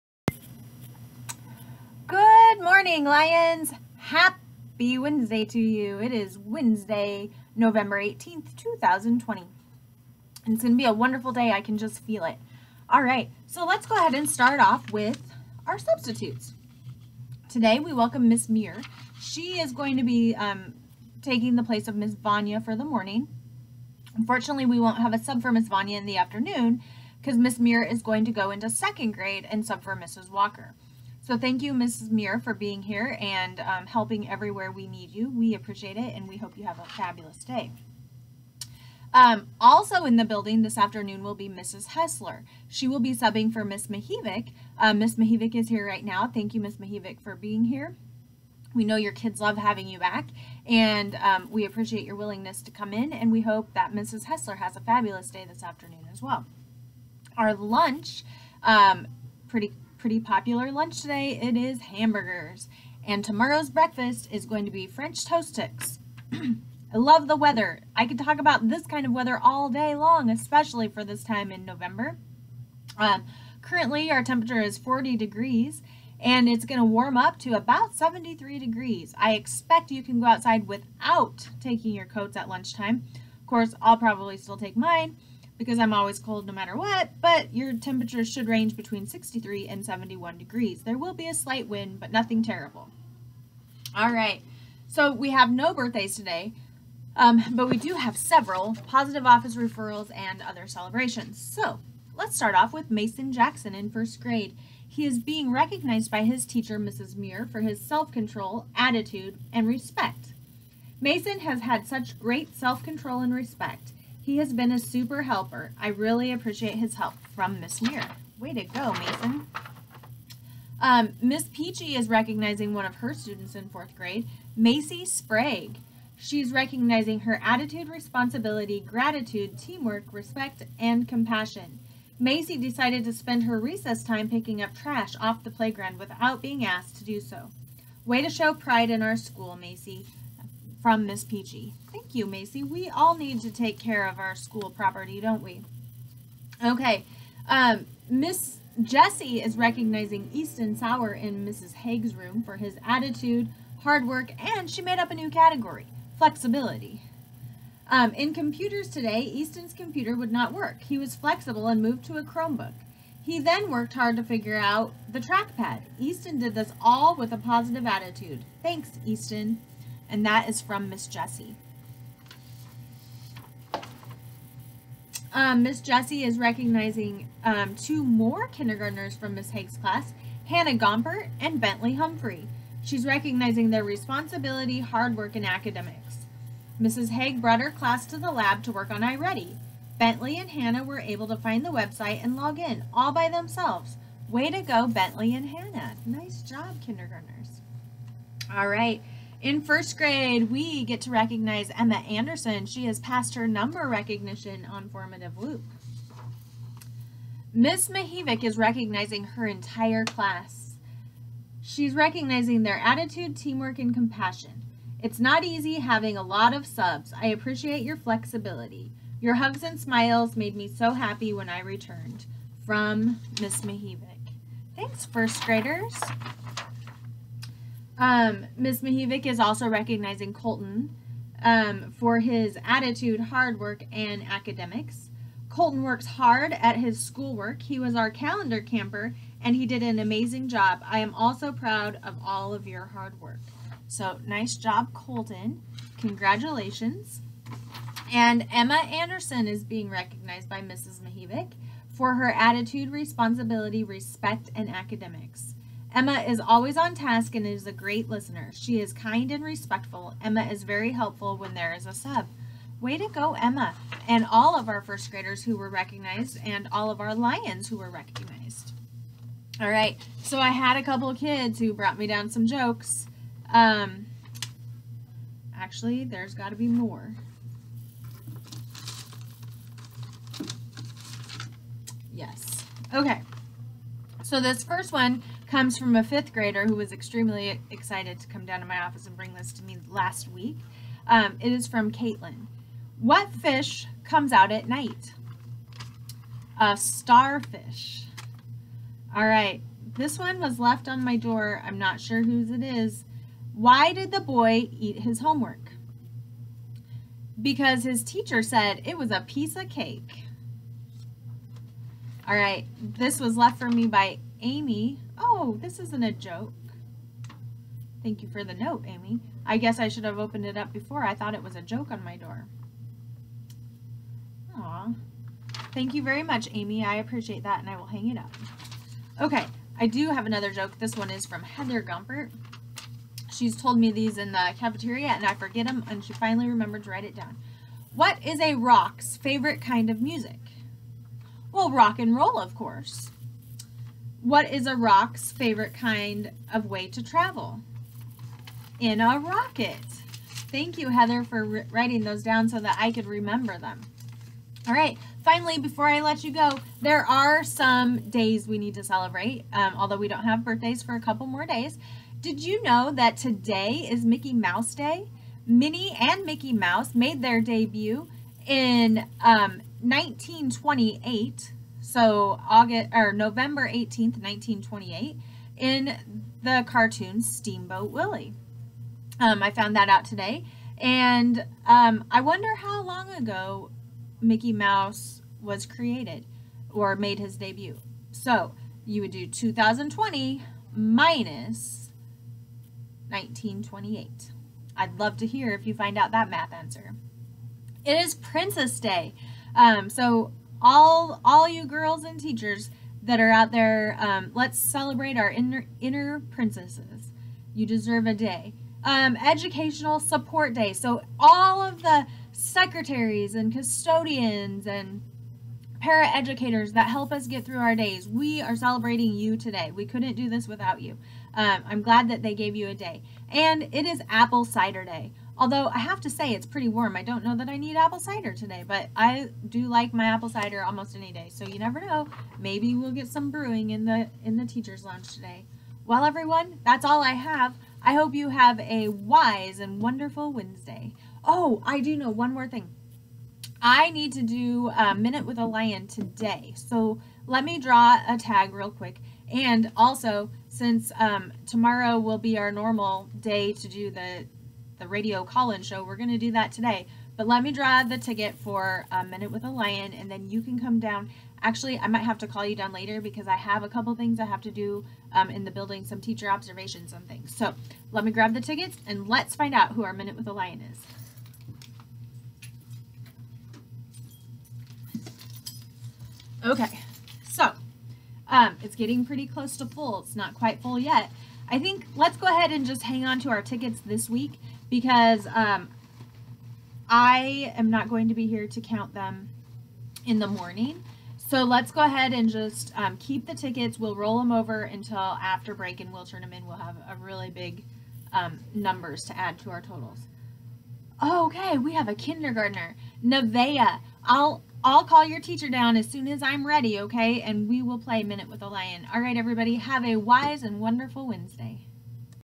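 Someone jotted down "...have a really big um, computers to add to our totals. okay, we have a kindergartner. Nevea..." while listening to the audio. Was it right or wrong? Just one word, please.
wrong.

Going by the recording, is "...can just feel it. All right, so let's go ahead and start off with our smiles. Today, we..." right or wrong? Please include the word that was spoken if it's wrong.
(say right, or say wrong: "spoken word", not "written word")
wrong: "substitutes", not "smiles".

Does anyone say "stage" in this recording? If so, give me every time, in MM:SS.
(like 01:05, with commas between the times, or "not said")
not said.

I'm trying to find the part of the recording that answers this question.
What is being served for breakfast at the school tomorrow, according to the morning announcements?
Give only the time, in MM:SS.
01:04.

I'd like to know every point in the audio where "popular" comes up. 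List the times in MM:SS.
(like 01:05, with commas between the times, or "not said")
01:00.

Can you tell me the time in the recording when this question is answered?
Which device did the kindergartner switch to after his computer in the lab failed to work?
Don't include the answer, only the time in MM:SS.
02:42.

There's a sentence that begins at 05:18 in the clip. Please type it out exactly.
Thank you for the note, Amy.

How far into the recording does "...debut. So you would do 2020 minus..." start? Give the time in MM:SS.
06:27.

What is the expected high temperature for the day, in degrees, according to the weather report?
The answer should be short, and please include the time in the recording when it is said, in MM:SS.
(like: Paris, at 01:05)
73, at 01:17.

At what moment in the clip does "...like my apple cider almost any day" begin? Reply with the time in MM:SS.
07:09.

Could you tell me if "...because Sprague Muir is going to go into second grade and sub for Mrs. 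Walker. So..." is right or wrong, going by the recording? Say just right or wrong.
wrong.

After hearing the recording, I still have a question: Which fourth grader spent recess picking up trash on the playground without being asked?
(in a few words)
Macy Sprague.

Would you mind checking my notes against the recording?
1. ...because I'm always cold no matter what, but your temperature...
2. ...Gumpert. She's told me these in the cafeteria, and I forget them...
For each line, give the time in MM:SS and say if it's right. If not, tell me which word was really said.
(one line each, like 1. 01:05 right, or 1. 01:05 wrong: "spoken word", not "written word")
1. 01:25 right
2. 05:31 right.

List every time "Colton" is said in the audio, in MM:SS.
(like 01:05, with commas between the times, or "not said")
03:50, 03:55, 04:04.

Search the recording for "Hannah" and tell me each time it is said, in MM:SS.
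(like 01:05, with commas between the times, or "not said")
03:00, 03:10, 03:15.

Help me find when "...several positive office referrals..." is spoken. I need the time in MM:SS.
01:38.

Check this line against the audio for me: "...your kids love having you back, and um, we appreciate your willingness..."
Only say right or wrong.
right.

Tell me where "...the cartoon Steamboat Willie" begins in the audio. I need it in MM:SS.
06:16.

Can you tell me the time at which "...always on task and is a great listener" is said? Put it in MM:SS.
04:16.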